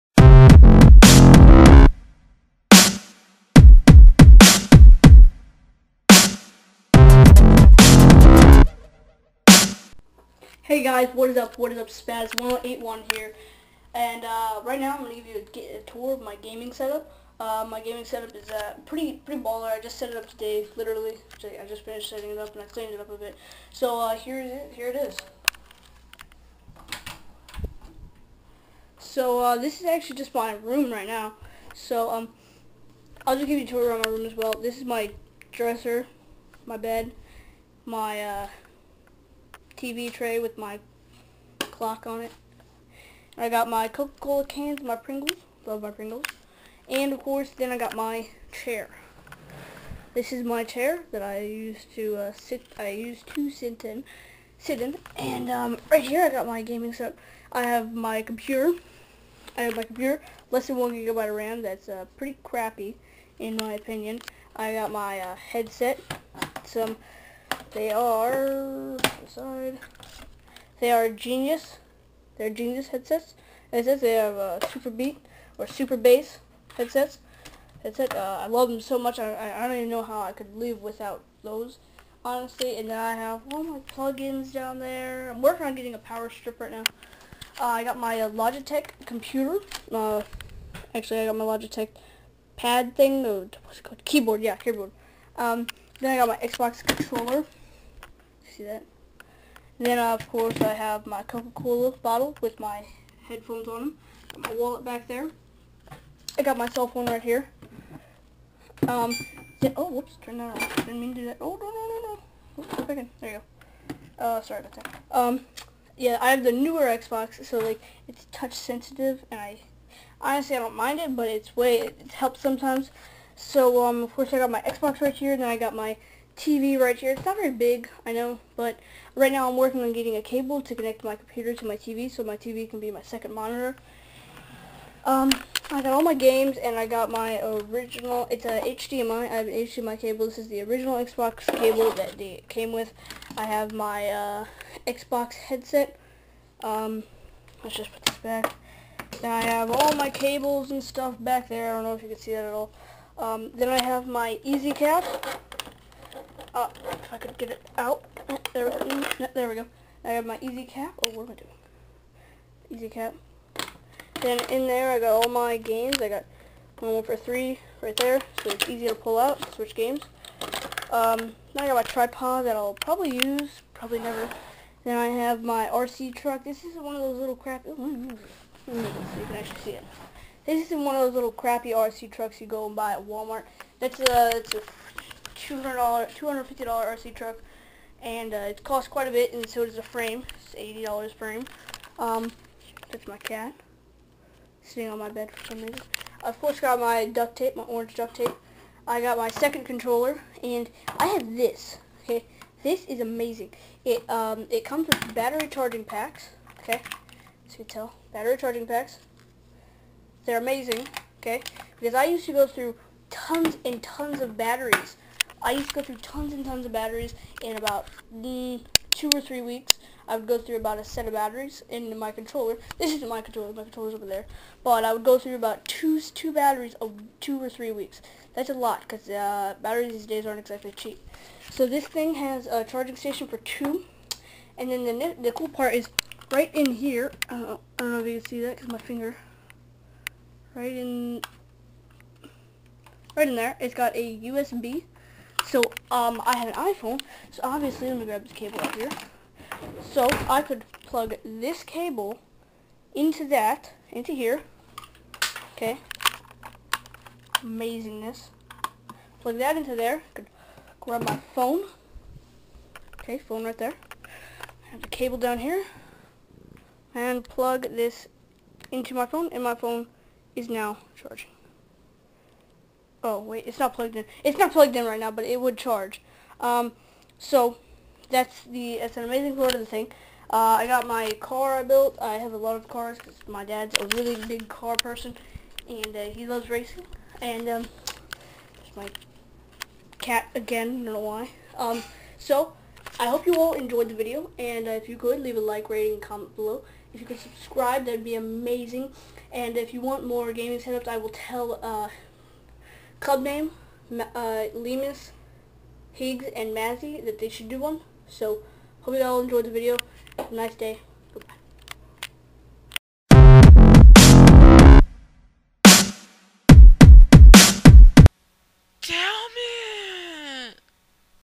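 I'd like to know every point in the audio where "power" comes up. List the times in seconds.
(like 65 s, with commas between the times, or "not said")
85 s.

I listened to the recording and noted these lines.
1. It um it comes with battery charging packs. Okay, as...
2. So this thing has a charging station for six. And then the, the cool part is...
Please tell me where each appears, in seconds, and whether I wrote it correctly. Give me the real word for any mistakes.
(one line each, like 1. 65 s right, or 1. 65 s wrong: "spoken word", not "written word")
1. 203 s right
2. 231 s wrong: "two", not "six".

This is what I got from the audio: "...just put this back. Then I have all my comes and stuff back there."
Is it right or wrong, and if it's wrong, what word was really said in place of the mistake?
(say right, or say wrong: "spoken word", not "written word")
wrong: "cables", not "comes".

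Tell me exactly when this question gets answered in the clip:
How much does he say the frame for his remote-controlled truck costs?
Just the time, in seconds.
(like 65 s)
190 s.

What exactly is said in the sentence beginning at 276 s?
Um, so, that's the, that's an amazing part of the thing.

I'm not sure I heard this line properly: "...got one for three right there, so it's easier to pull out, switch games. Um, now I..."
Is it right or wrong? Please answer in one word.
right.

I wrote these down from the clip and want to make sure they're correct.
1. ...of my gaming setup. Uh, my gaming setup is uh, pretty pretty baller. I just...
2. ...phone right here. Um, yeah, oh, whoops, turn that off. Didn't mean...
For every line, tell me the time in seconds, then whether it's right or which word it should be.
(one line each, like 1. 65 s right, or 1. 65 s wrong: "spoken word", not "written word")
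1. 16 s right
2. 106 s right.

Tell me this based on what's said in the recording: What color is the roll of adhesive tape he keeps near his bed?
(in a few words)
Orange.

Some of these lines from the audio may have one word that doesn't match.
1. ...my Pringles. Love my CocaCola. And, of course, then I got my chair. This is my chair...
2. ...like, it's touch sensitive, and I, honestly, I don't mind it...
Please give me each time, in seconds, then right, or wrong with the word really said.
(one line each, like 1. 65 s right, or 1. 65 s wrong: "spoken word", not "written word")
1. 44 s wrong: "Pringles", not "CocaCola"
2. 117 s right.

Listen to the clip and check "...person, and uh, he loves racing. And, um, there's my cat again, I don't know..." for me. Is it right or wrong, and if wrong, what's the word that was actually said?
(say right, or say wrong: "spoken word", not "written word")
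right.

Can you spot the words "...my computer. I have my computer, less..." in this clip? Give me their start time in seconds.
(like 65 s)
57 s.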